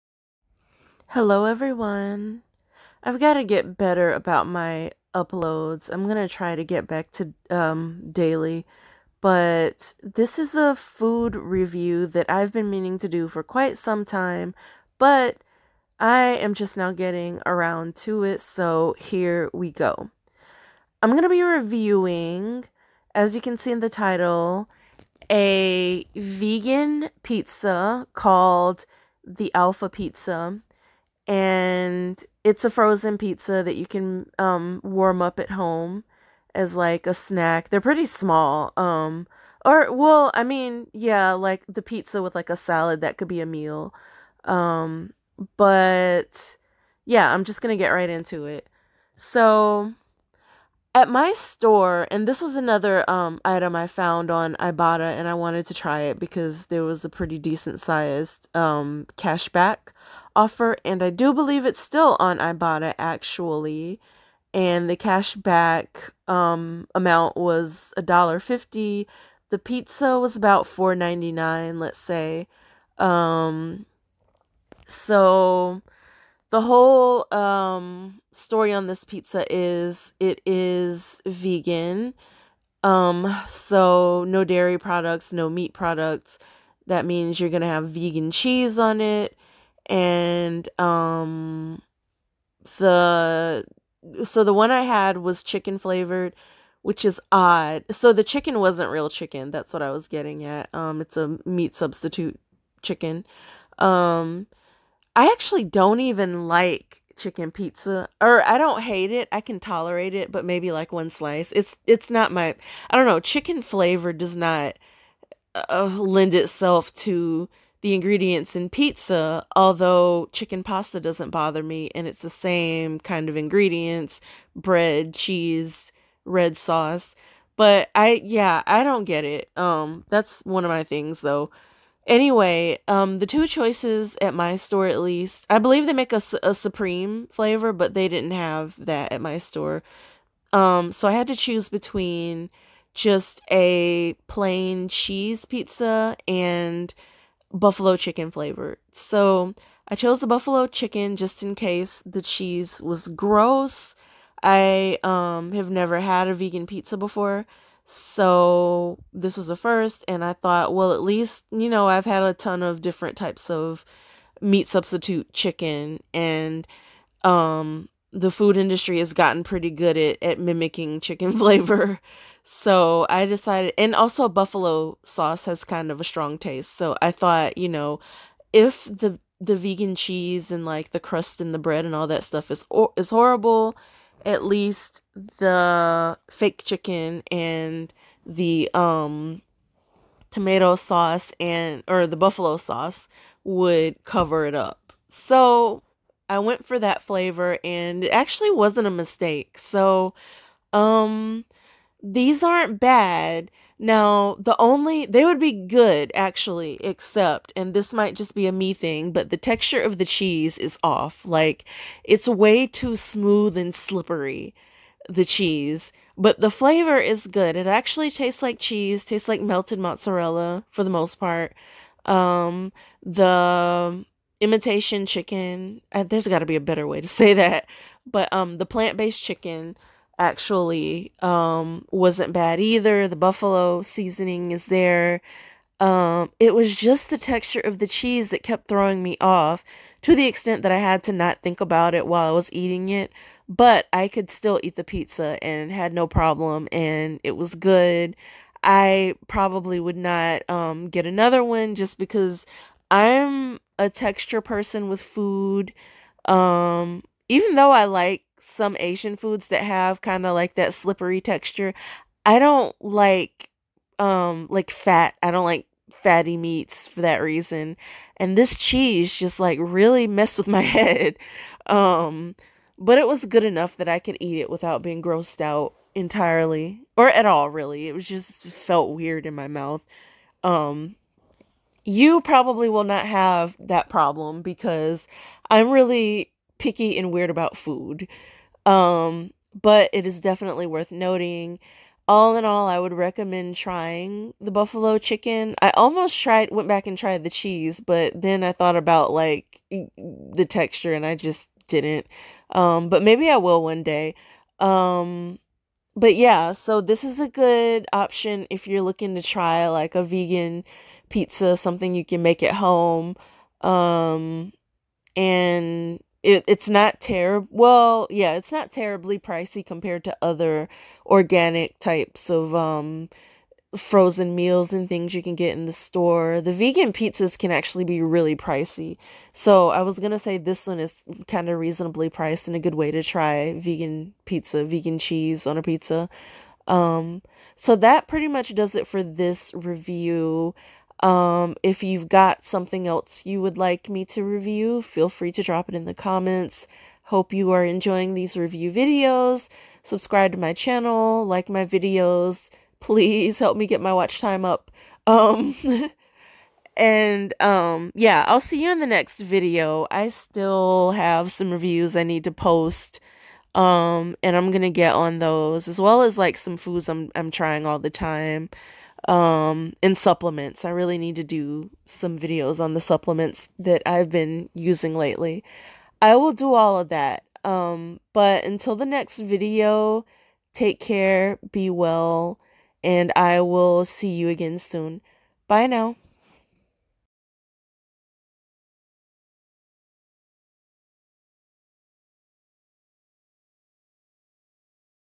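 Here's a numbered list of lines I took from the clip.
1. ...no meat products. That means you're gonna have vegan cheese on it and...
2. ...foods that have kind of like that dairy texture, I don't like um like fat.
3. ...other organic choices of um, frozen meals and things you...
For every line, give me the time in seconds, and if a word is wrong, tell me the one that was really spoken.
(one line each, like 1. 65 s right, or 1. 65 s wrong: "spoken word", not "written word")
1. 85 s right
2. 259 s wrong: "slippery", not "dairy"
3. 320 s wrong: "types", not "choices".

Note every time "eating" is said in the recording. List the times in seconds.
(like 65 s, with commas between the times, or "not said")
242 s.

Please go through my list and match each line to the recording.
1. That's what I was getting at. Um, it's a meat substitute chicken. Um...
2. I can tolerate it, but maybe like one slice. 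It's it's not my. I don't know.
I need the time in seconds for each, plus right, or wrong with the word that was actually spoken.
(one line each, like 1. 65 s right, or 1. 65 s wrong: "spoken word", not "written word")
1. 99 s right
2. 109 s right.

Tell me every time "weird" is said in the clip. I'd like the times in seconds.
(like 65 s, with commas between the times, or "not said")
278 s, 287 s.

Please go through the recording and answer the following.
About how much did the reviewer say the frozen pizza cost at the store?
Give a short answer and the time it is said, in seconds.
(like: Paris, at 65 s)
$4.99, at 70 s.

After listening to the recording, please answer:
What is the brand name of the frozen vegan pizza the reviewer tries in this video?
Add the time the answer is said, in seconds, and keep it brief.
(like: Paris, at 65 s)
Alpha Pizza, at 29 s.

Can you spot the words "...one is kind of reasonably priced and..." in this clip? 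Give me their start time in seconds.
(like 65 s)
330 s.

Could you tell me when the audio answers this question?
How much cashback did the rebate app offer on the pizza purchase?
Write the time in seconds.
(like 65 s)
67 s.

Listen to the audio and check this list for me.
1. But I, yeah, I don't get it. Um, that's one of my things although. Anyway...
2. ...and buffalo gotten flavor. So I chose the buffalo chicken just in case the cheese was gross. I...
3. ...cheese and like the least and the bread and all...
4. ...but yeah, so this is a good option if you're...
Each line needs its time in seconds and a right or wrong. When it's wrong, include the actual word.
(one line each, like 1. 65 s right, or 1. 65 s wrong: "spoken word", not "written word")
1. 127 s wrong: "though", not "although"
2. 146 s wrong: "chicken", not "gotten"
3. 179 s wrong: "crust", not "least"
4. 305 s right.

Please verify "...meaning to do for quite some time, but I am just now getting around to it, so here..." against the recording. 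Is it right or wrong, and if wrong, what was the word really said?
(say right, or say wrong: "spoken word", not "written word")
right.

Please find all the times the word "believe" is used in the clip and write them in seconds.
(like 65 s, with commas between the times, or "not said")
61 s, 135 s.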